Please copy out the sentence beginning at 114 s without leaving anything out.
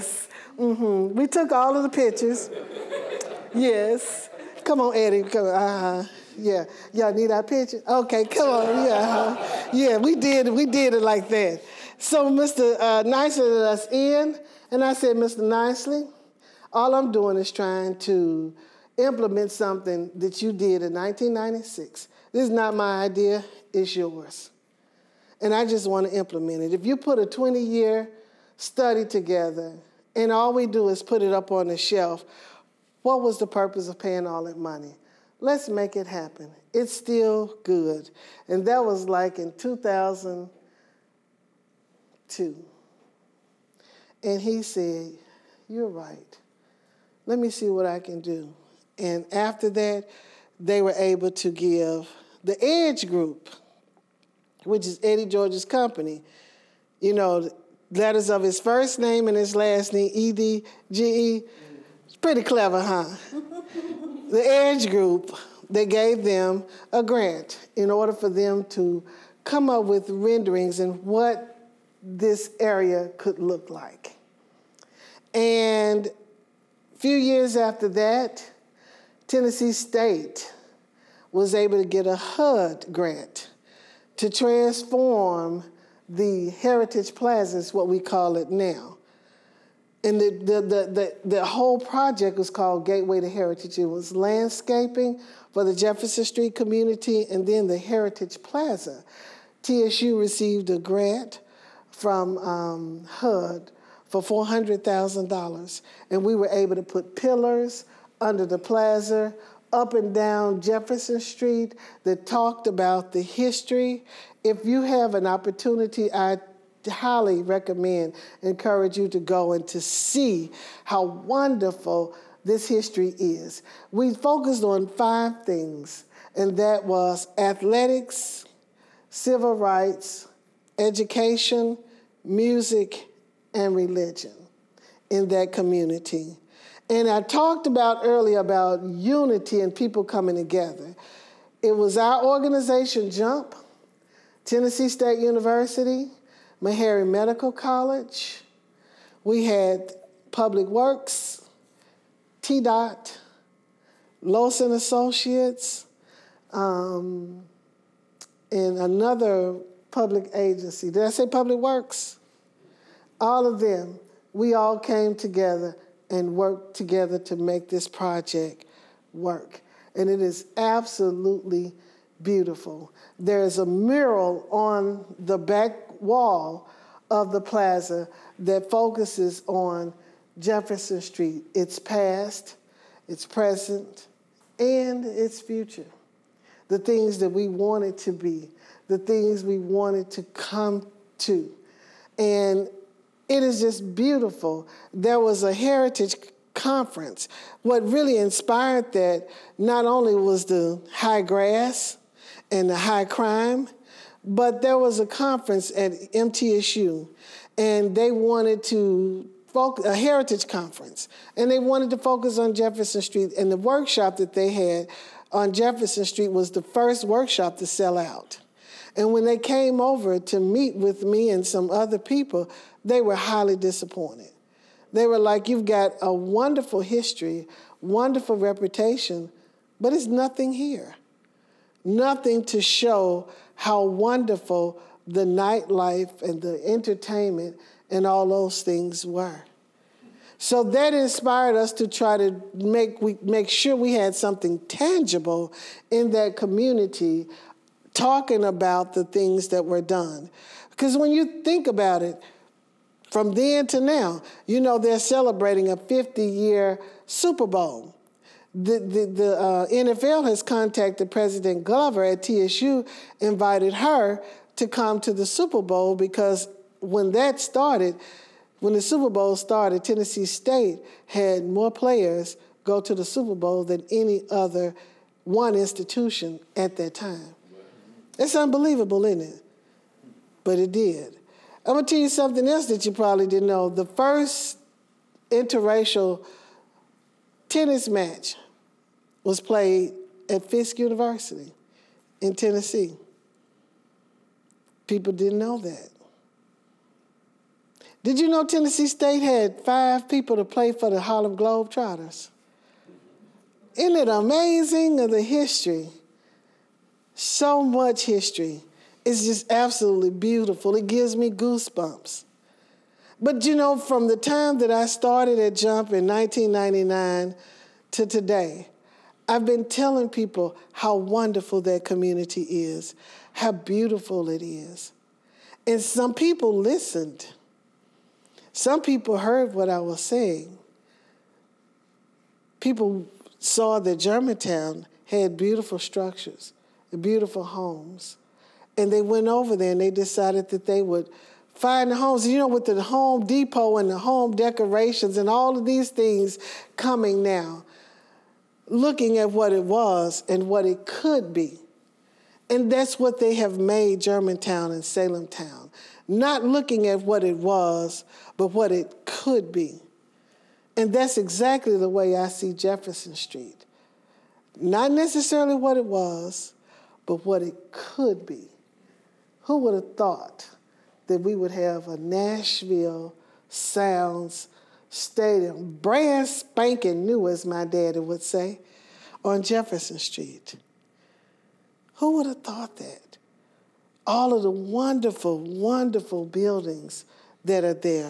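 If you have an opportunity, I highly recommend, encourage you to go and to see how wonderful this history is.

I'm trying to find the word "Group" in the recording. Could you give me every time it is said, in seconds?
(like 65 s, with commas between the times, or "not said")
53 s, 64 s.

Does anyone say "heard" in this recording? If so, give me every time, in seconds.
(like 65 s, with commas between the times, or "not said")
329 s.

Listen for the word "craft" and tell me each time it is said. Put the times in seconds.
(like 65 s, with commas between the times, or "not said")
not said.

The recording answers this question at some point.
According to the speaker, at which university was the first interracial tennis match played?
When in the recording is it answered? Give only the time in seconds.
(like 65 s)
290 s.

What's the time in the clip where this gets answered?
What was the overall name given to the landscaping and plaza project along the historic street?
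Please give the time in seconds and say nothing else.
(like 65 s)
92 s.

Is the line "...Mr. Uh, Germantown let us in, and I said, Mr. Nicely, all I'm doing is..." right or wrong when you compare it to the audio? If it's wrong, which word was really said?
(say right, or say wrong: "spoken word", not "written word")
wrong: "Nicely", not "Germantown".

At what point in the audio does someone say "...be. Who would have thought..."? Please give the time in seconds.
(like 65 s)
368 s.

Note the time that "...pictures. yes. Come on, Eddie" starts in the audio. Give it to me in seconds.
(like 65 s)
1 s.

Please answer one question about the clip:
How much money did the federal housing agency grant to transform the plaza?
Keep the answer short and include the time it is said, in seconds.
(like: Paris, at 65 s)
$400,000, at 104 s.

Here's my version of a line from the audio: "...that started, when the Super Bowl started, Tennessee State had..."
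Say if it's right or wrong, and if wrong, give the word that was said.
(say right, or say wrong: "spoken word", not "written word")
right.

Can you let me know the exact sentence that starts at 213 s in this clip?
And the workshop that they had on Jefferson Street was the first workshop to sell out.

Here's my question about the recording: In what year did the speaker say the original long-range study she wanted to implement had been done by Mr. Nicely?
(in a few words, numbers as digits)
1996.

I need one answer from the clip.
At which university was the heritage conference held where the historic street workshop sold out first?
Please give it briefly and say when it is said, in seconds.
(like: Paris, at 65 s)
MTSU, at 206 s.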